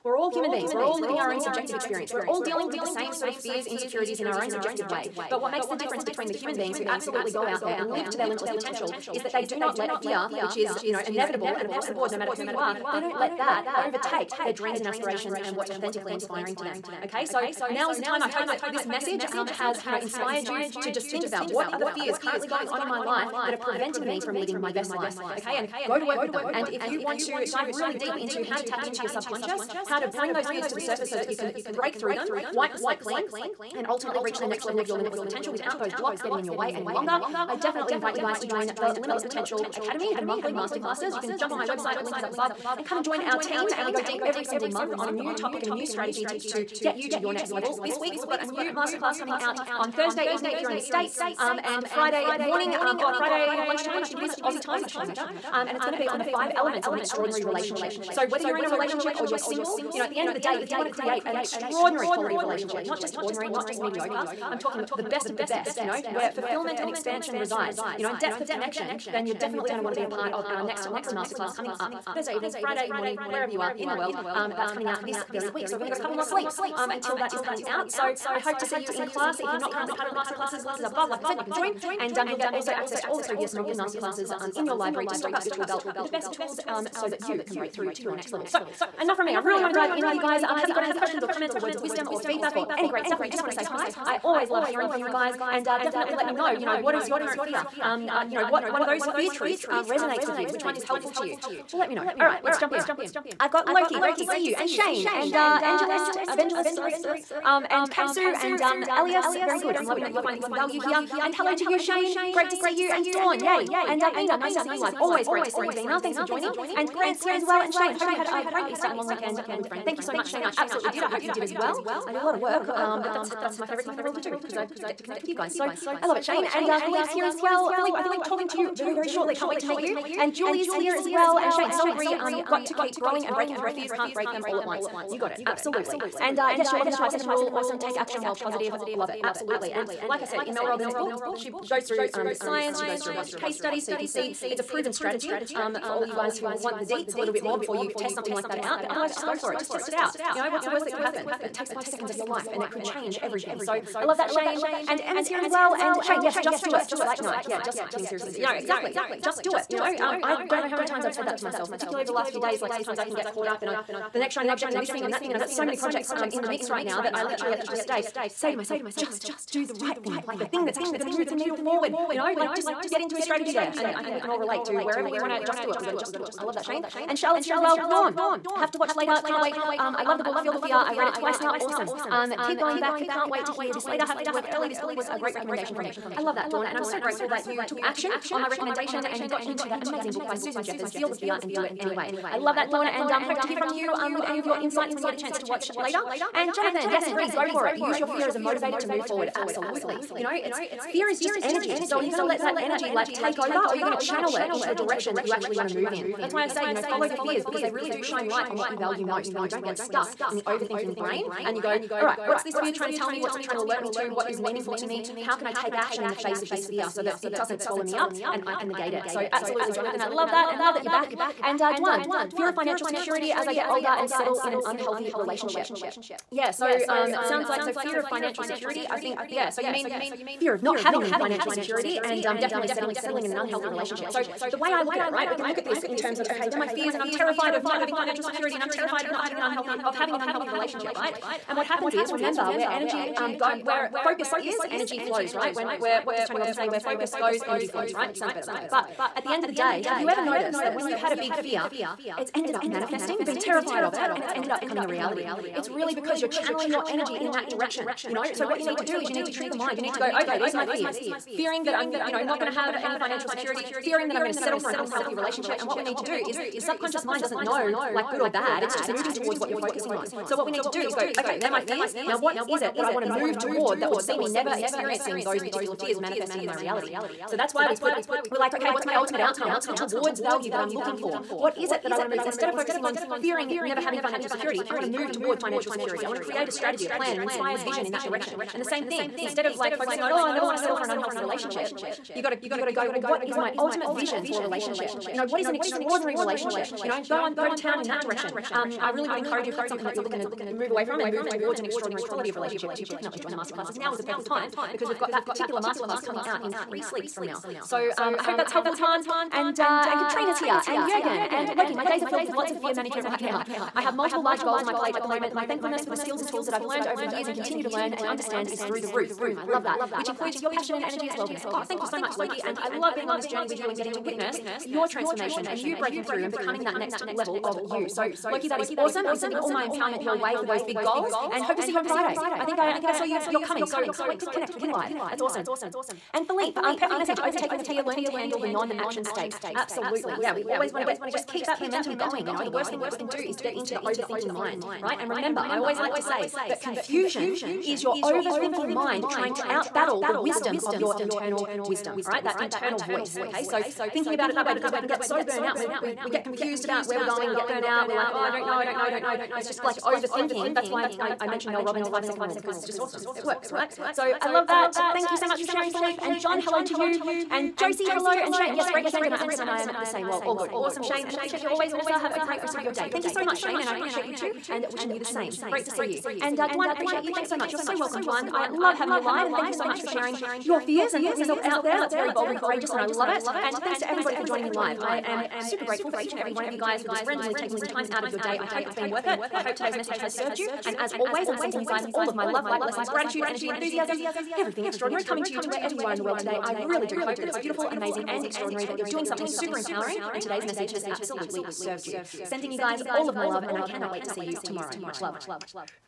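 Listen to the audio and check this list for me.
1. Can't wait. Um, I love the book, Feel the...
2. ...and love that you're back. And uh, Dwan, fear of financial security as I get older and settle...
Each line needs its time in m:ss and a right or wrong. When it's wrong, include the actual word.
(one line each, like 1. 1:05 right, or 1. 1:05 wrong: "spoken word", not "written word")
1. 2:59 right
2. 3:40 right.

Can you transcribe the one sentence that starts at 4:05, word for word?
When where what does Tony Robbins say?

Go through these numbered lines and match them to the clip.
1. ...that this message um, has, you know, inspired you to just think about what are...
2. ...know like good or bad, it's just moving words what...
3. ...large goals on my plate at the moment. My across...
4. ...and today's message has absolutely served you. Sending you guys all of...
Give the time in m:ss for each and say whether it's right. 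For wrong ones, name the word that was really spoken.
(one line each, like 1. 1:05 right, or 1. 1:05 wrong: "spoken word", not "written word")
1. 0:18 right
2. 4:27 wrong: "towards", not "words"
3. 5:14 wrong: "thankfulness", not "across"
4. 6:40 right.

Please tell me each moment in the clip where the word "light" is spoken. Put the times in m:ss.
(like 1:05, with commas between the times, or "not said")
3:28, 6:32.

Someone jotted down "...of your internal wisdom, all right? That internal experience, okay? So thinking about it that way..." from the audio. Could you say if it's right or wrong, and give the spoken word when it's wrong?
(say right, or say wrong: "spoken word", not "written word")
wrong: "voice", not "experience".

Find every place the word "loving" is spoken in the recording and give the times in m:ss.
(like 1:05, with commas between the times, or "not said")
1:49, 2:16.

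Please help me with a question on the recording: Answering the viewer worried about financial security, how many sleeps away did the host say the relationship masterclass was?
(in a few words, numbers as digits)
3.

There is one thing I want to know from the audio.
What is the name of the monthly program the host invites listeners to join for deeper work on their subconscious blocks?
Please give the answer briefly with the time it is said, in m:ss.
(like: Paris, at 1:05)
Limitless Potential Academy, at 0:38.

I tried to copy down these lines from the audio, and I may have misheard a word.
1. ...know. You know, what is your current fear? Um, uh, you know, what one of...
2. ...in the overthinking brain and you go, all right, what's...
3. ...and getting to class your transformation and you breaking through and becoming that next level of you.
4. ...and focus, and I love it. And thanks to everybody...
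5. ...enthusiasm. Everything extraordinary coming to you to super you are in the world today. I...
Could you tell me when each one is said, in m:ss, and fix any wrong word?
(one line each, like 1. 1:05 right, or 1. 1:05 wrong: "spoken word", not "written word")
1. 1:36 right
2. 3:30 right
3. 5:23 wrong: "witness", not "class"
4. 6:22 wrong: "courageous", not "focus"
5. 6:33 wrong: "wherever", not "super".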